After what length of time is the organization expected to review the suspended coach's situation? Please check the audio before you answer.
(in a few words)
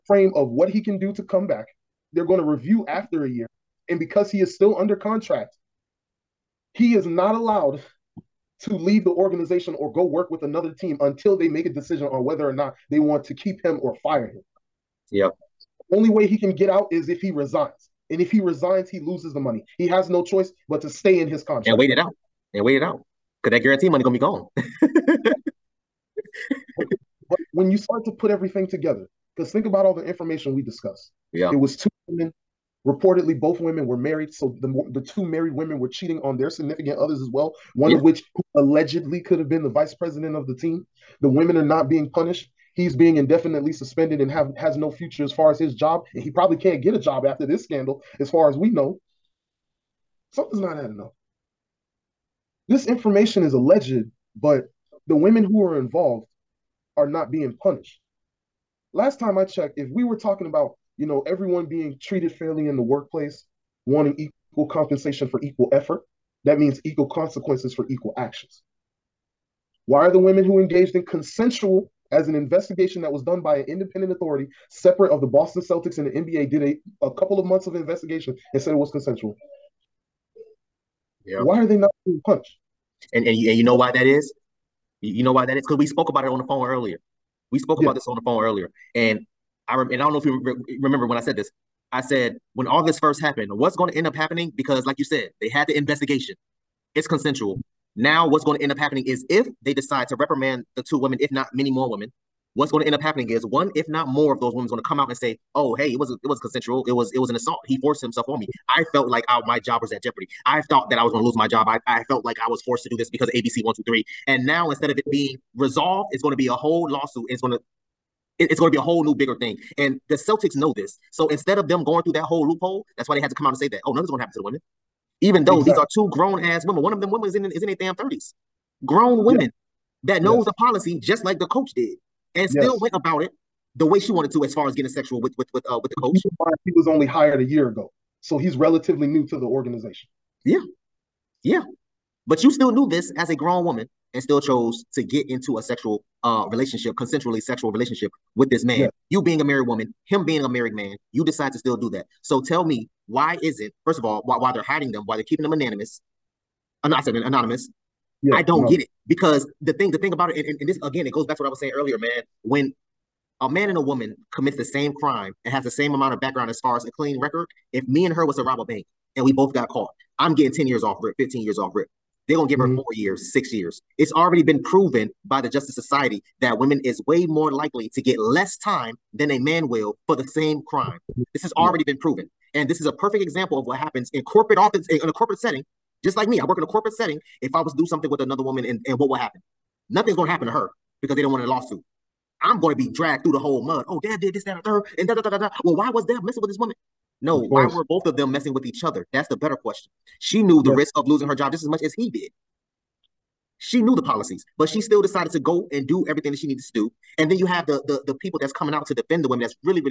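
1 year.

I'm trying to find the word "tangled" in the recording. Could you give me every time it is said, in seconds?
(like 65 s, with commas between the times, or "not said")
not said.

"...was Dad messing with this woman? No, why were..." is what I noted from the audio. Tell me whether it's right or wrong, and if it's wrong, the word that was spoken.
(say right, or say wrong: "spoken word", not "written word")
right.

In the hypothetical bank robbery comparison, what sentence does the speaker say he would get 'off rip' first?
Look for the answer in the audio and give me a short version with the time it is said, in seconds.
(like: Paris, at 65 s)
10 years, at 170 s.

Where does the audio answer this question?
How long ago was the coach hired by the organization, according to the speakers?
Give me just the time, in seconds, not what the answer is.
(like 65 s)
137 s.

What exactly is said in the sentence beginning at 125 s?
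these are two grown ass women, one of them women is in is in their damn thirties, grown women yeah.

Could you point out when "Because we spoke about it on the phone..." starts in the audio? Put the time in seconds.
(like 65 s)
85 s.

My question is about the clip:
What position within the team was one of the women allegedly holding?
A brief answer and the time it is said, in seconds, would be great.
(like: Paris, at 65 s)
vice president, at 39 s.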